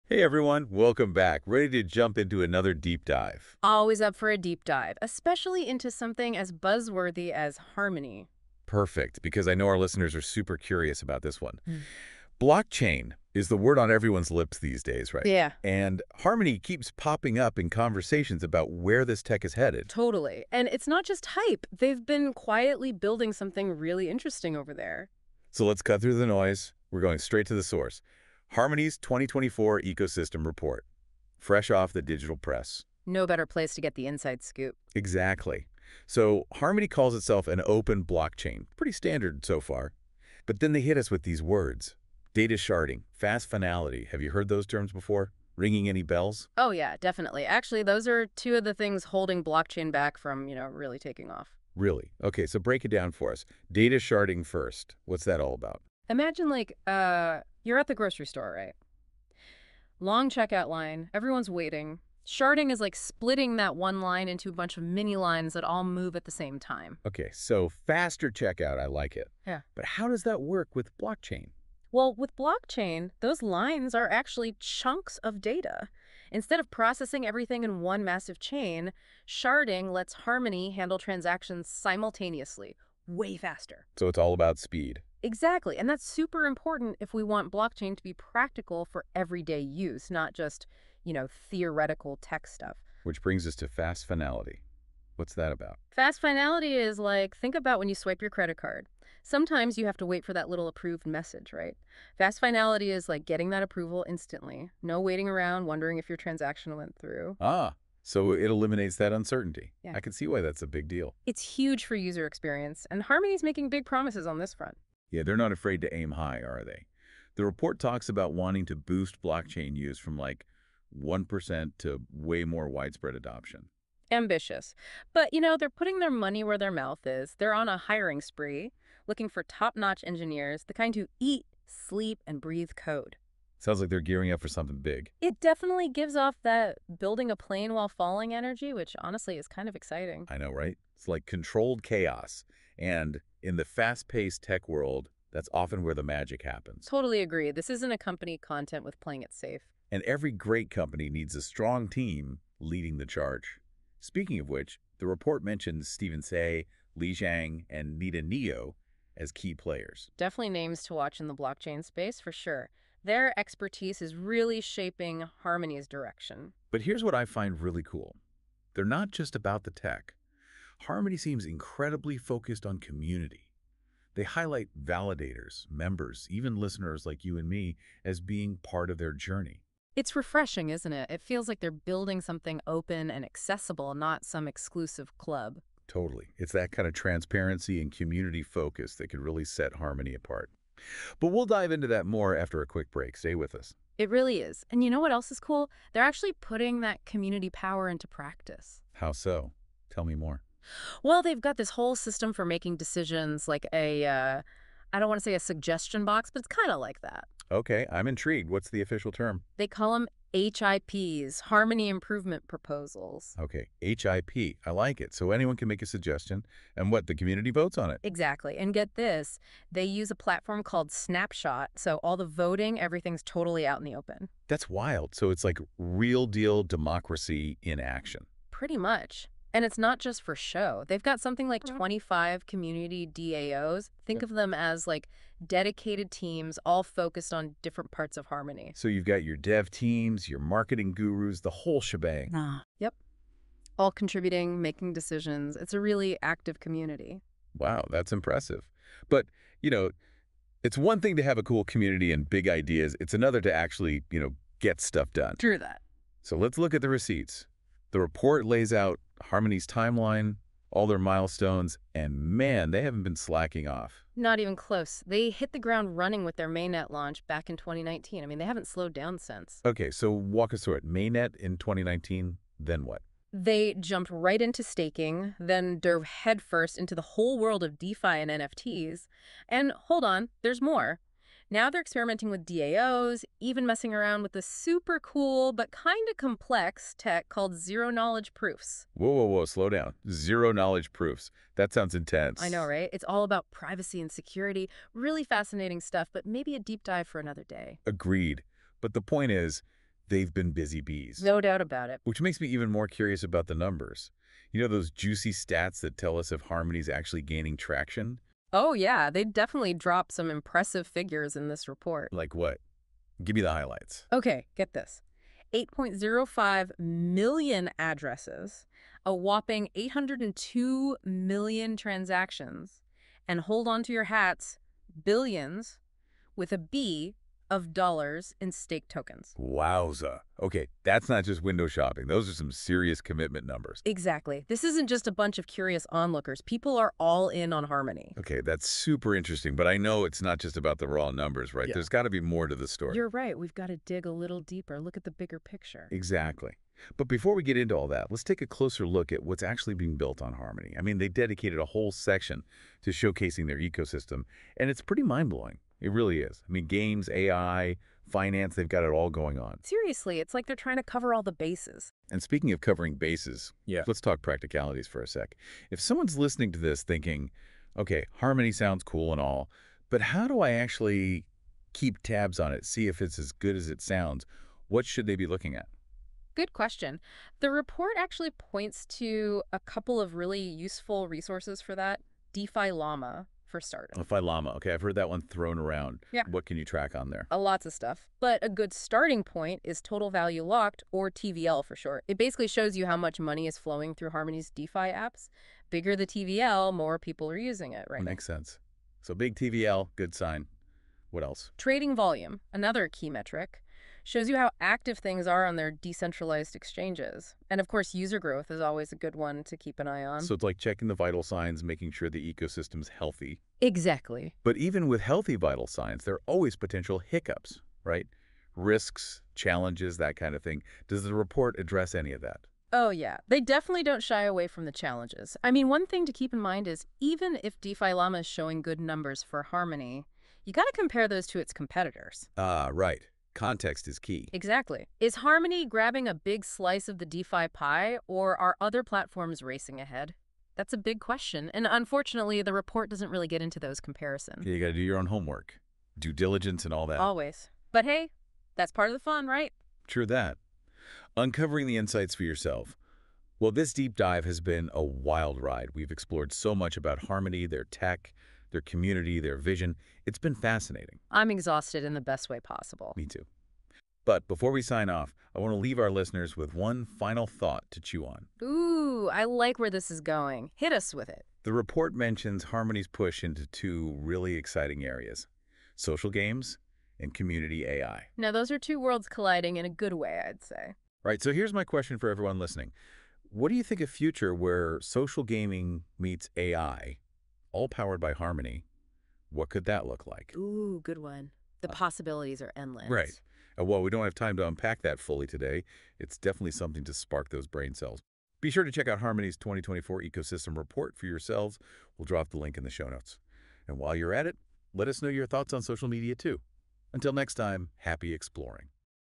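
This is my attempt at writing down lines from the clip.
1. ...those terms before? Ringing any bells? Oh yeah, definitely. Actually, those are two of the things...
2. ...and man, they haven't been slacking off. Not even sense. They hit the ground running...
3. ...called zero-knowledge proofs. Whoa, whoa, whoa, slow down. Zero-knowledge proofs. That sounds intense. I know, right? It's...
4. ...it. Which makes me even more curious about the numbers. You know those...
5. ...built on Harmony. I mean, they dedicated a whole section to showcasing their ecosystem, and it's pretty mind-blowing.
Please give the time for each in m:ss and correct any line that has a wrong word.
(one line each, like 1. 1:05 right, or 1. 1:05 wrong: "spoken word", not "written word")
1. 0:44 right
2. 4:21 wrong: "close", not "sense"
3. 4:47 right
4. 5:01 right
5. 5:49 right.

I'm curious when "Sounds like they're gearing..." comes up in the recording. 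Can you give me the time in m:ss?
2:13.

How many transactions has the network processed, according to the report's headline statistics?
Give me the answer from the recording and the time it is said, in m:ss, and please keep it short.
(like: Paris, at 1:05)
802 million, at 5:19.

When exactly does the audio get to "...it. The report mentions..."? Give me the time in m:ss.
7:51.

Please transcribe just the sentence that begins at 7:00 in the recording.
Does the report address any of that?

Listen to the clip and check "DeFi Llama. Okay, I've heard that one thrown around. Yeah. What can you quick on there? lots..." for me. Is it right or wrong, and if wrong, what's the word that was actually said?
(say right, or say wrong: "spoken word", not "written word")
wrong: "track", not "quick".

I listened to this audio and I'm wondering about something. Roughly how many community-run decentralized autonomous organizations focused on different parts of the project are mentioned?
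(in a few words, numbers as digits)
25.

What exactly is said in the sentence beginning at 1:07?
Okay, so faster checkout, I like it.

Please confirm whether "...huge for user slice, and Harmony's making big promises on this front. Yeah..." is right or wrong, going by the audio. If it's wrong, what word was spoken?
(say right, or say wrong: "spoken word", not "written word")
wrong: "experience", not "slice".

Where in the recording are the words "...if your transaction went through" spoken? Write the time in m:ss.
1:45.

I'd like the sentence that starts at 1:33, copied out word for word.
Which brings us to fast finality.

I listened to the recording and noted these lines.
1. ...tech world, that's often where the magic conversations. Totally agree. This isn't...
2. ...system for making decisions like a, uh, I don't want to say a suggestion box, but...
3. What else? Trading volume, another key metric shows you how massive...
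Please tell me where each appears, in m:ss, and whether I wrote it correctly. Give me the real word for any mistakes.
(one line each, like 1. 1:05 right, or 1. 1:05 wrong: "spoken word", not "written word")
1. 2:24 wrong: "happens", not "conversations"
2. 3:21 right
3. 6:41 wrong: "active", not "massive".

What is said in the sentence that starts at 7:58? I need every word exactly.
Now, those are two worlds colliding in a good way, I'd say.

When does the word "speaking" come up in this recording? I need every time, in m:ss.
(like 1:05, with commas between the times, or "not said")
2:33, 6:02.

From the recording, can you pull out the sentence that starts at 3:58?
So you've got your dev teams, your marketing gurus, the whole shebang.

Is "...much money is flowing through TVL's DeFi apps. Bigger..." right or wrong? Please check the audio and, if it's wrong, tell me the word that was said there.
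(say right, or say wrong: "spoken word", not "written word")
wrong: "Harmony", not "TVL".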